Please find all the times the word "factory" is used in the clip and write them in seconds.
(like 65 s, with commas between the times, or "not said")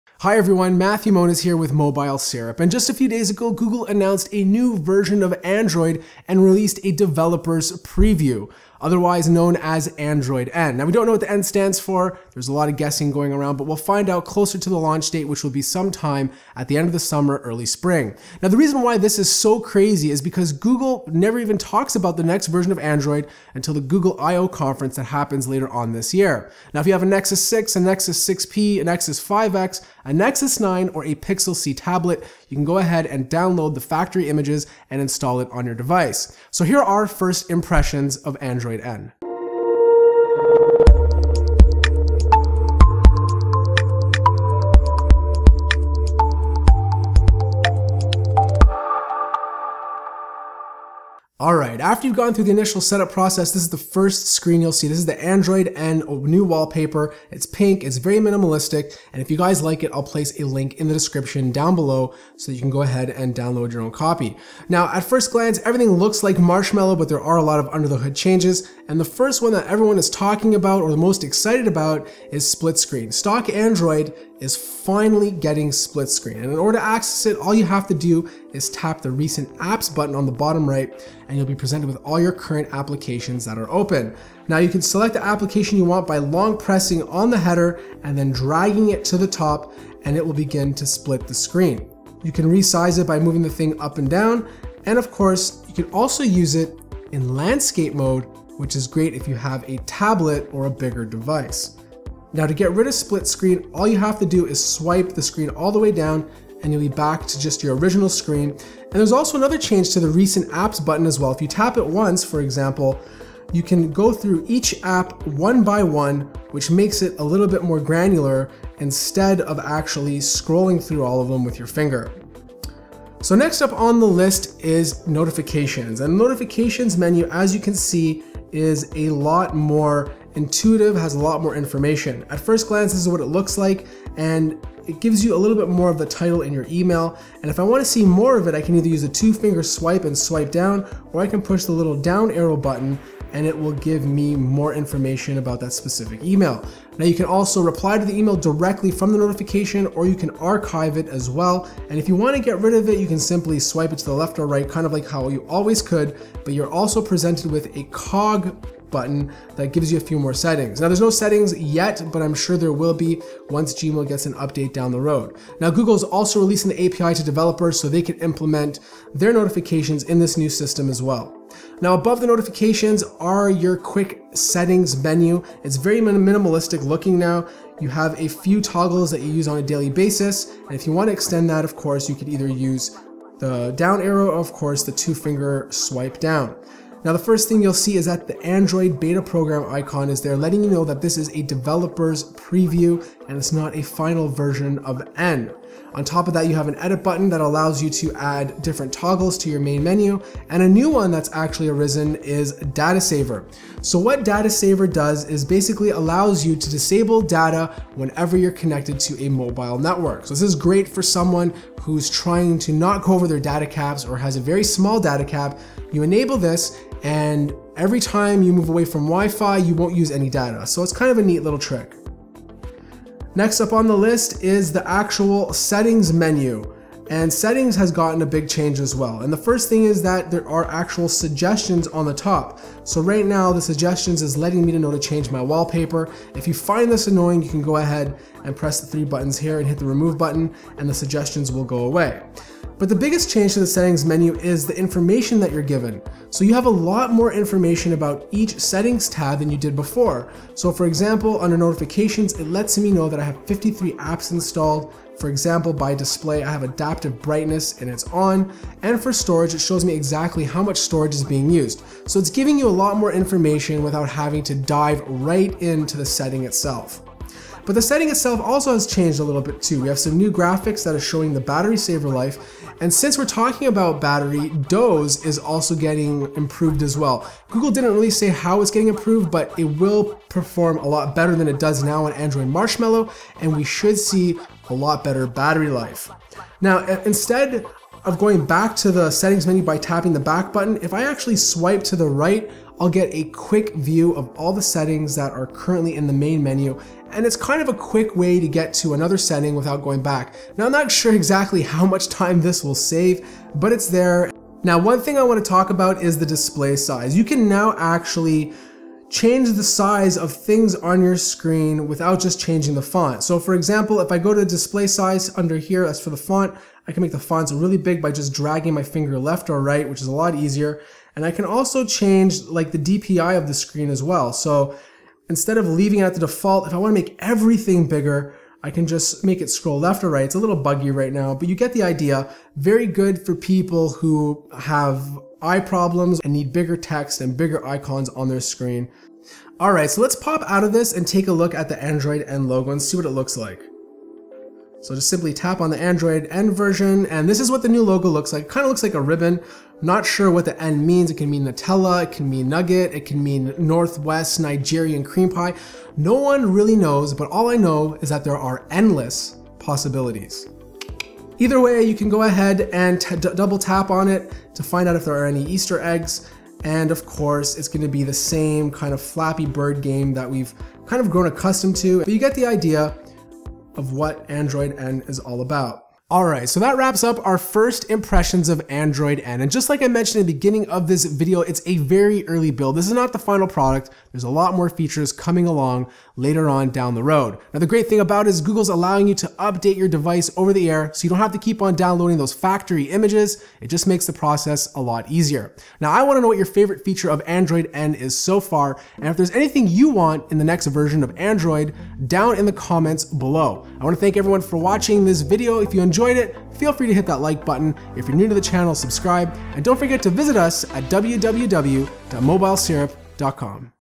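33 s, 392 s.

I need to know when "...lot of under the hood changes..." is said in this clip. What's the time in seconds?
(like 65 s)
67 s.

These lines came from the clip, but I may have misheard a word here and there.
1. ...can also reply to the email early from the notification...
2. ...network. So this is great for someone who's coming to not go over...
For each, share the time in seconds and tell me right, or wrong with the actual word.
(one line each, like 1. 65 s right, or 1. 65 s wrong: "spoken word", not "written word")
1. 147 s wrong: "directly", not "early"
2. 209 s wrong: "trying", not "coming".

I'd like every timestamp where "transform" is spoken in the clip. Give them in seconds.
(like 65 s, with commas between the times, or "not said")
not said.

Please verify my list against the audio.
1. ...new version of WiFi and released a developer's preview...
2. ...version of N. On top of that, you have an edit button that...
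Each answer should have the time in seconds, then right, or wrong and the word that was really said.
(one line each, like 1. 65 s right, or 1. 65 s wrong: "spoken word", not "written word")
1. 4 s wrong: "Android", not "WiFi"
2. 194 s right.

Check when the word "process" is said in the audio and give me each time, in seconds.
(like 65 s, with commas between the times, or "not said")
53 s, 394 s.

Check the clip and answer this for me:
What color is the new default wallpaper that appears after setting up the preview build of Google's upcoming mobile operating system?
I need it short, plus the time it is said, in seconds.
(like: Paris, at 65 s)
Pink, at 57 s.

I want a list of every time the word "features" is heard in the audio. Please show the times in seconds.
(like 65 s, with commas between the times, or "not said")
384 s, 396 s.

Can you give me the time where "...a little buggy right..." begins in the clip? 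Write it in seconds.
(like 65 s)
330 s.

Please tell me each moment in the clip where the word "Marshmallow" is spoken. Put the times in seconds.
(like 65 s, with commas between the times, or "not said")
66 s, 282 s.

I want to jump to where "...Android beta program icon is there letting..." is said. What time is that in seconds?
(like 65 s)
188 s.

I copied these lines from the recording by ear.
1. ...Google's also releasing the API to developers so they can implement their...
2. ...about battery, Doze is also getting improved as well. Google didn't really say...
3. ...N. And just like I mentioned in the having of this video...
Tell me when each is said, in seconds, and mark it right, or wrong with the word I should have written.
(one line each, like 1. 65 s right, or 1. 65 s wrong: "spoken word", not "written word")
1. 165 s right
2. 273 s right
3. 379 s wrong: "beginning", not "having".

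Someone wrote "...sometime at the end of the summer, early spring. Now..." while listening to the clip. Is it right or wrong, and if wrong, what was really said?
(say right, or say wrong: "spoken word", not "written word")
right.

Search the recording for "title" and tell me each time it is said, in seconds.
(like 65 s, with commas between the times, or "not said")
136 s.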